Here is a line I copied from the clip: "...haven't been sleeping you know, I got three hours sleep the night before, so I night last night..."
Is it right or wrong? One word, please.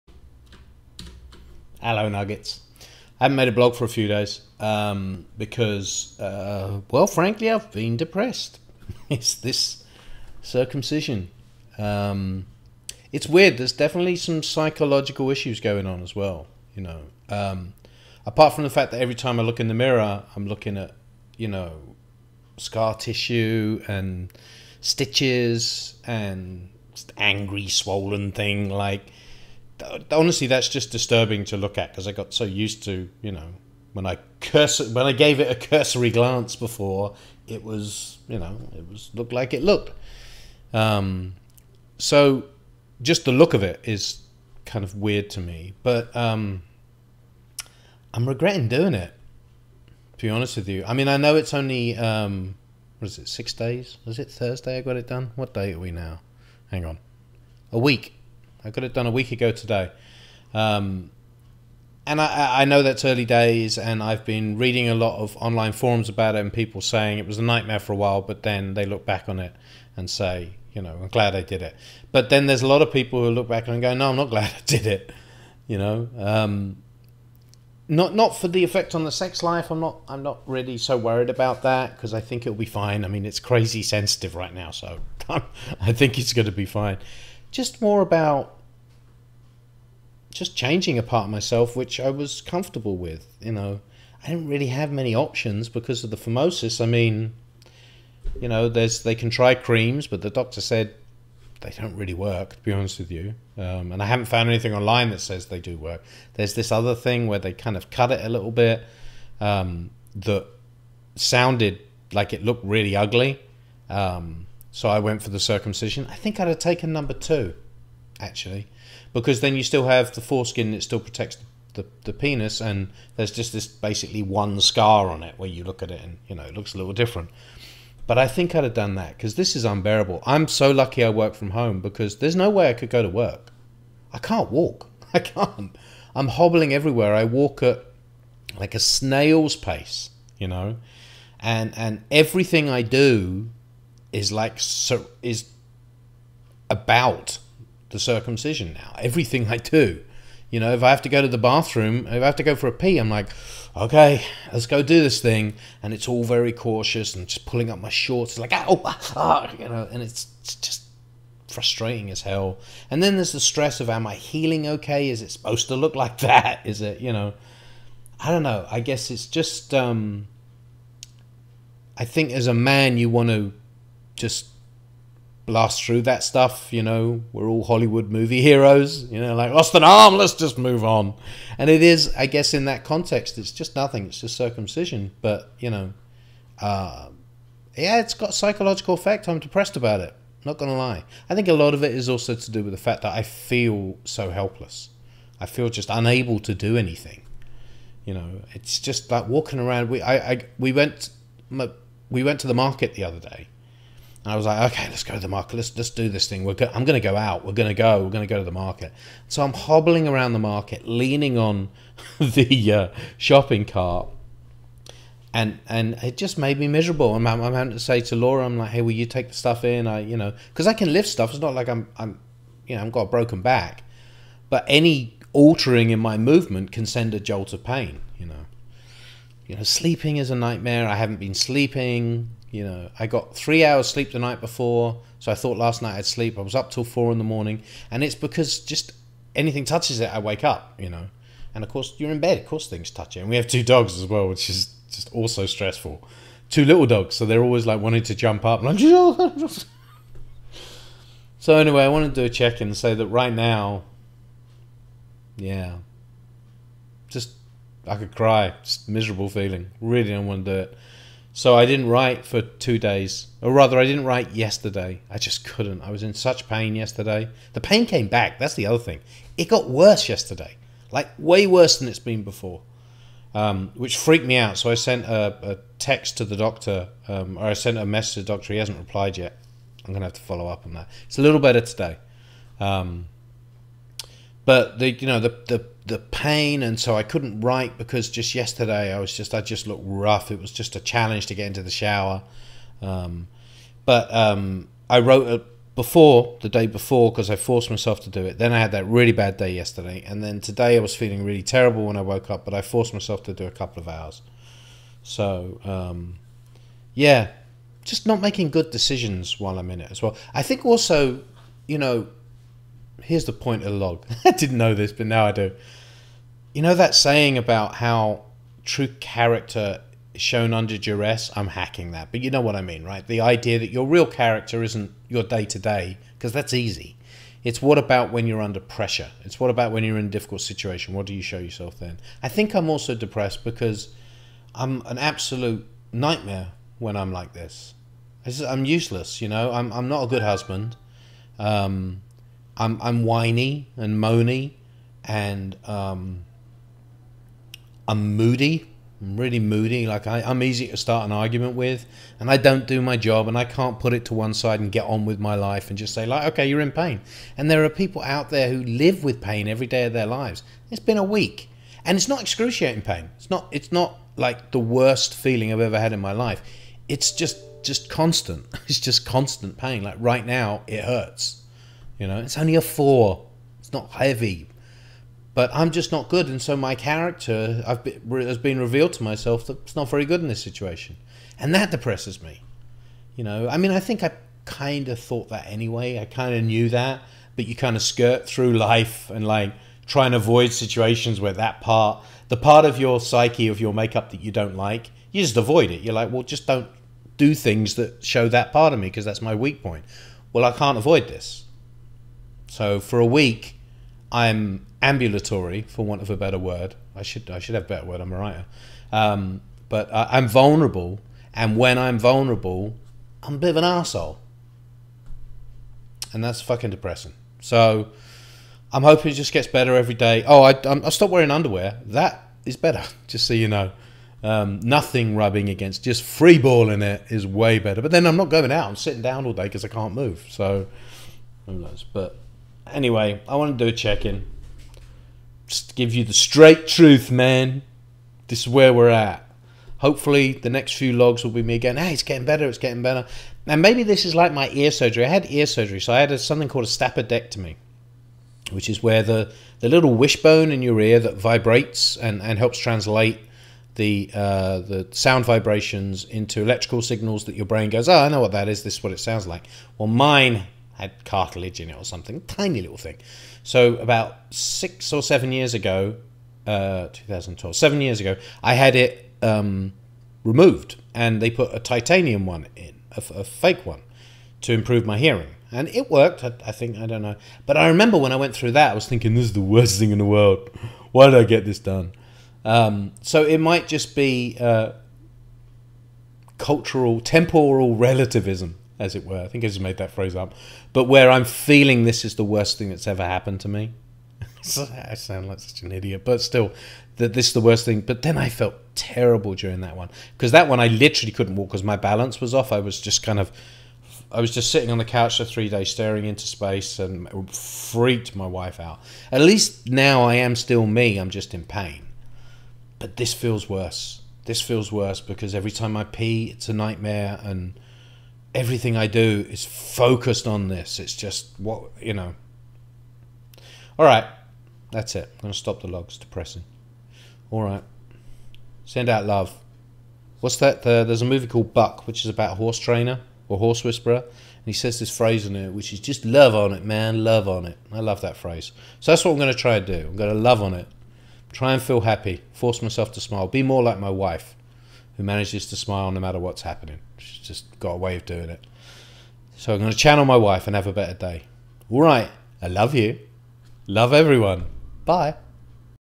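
wrong.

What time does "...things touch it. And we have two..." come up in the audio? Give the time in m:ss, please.
4:02.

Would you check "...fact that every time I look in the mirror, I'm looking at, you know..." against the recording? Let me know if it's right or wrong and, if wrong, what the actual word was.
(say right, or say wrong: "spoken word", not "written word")
right.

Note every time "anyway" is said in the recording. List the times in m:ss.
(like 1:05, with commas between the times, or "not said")
4:11, 6:25, 7:12.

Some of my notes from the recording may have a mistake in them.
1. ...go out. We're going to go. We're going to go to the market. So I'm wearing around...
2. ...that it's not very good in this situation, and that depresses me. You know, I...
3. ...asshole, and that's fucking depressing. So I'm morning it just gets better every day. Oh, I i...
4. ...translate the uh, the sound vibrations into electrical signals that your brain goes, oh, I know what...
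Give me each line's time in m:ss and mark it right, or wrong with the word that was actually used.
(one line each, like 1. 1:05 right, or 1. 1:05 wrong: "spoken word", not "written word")
1. 3:27 wrong: "hobbling", not "wearing"
2. 6:19 right
3. 6:53 wrong: "hoping", not "morning"
4. 7:32 right.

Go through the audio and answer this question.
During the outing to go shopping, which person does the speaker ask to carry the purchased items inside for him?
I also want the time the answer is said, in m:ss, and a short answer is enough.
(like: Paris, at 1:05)
Laura, at 3:38.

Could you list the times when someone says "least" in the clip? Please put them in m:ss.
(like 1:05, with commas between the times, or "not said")
8:29.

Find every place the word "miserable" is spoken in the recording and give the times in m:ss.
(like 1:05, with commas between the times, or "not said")
3:36, 4:18.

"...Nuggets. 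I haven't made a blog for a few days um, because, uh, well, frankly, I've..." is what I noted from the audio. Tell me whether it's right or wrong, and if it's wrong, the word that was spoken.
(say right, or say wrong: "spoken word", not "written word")
right.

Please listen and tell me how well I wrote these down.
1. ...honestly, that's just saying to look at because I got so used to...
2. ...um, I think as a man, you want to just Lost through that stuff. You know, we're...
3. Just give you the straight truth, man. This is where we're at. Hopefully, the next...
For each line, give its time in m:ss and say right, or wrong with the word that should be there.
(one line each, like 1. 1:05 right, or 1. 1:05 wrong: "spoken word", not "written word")
1. 0:30 wrong: "disturbing", not "saying"
2. 2:49 right
3. 7:15 right.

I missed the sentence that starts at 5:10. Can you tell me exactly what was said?
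I think also, you know, here's the point of the log.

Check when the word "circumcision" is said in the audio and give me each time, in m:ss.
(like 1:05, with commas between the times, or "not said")
0:10, 1:55, 2:27, 3:04.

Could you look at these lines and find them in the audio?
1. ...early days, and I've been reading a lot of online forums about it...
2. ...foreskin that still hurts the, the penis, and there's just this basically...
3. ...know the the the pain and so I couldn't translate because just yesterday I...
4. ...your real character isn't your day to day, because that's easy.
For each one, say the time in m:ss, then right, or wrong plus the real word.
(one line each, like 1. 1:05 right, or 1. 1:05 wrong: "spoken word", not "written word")
1. 1:03 right
2. 2:00 wrong: "protects", not "hurts"
3. 4:45 wrong: "write", not "translate"
4. 5:23 right.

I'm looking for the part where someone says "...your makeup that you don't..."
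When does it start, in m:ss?
6:33.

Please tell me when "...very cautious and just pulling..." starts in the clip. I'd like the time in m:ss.
2:36.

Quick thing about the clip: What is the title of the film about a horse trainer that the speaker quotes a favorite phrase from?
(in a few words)
Buck.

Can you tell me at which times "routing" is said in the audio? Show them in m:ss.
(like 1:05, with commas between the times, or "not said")
not said.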